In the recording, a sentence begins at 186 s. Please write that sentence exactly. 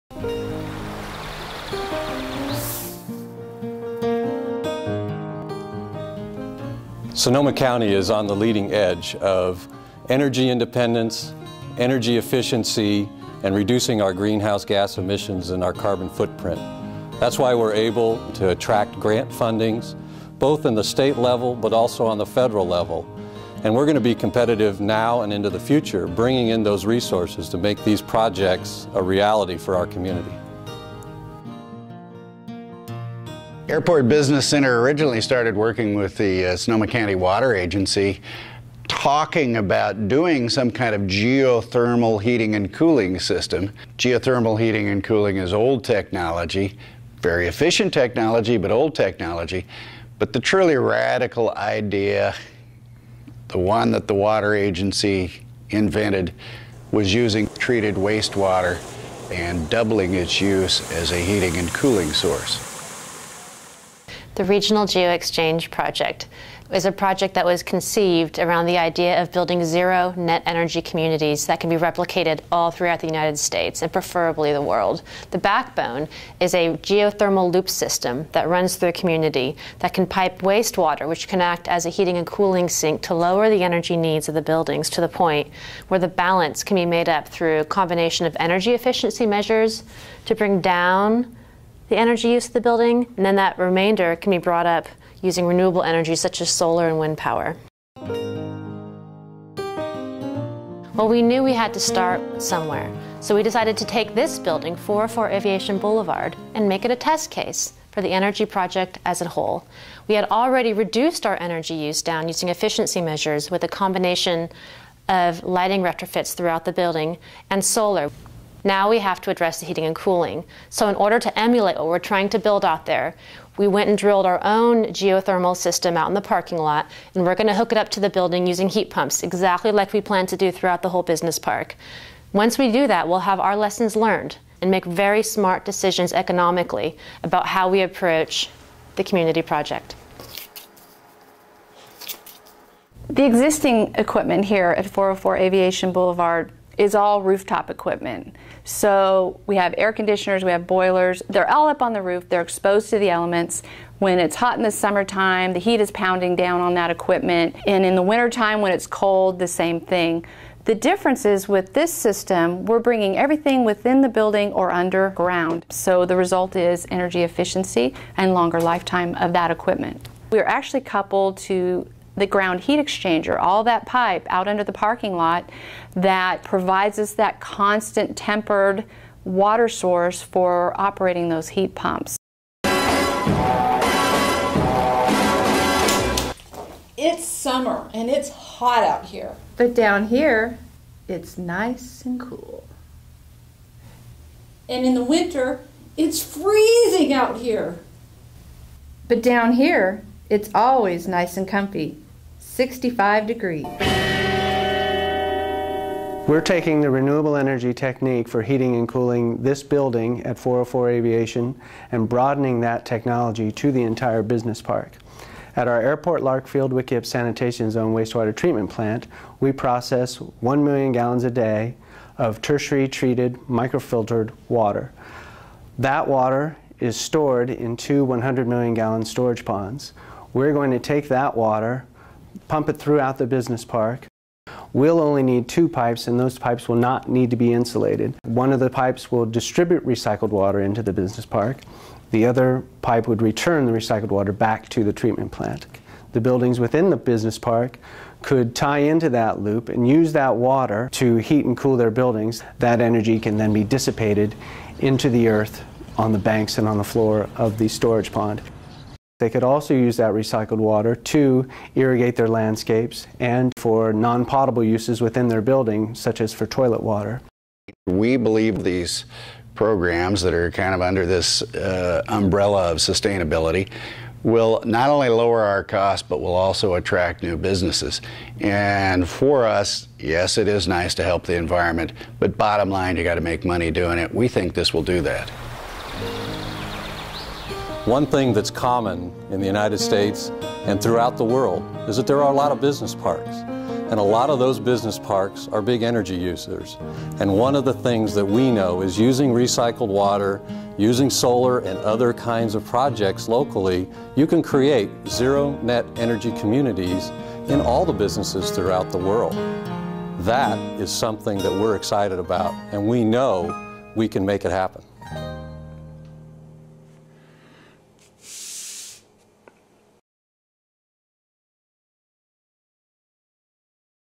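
It's summer and it's hot out here.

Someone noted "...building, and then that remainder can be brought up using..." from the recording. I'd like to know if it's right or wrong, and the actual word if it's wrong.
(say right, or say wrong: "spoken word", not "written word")
right.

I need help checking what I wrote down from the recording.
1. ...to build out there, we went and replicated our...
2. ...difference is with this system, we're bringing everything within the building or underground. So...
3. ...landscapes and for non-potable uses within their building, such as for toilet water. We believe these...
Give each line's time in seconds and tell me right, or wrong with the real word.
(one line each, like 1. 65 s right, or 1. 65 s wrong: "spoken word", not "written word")
1. 122 s wrong: "drilled", not "replicated"
2. 160 s right
3. 262 s right.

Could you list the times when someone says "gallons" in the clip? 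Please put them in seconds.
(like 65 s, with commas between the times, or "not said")
220 s, 228 s.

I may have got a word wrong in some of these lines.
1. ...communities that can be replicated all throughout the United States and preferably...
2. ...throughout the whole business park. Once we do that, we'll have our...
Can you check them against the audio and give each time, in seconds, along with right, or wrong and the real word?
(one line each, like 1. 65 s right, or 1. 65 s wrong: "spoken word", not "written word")
1. 70 s right
2. 130 s right.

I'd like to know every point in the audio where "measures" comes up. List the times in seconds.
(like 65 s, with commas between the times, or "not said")
89 s, 113 s.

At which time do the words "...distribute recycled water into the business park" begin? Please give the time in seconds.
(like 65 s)
239 s.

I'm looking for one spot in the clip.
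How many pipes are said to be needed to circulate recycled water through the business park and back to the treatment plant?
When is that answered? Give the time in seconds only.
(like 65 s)
235 s.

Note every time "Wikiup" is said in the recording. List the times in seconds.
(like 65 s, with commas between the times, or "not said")
216 s.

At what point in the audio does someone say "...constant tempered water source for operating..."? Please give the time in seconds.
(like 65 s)
177 s.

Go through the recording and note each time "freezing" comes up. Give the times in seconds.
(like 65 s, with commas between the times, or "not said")
196 s.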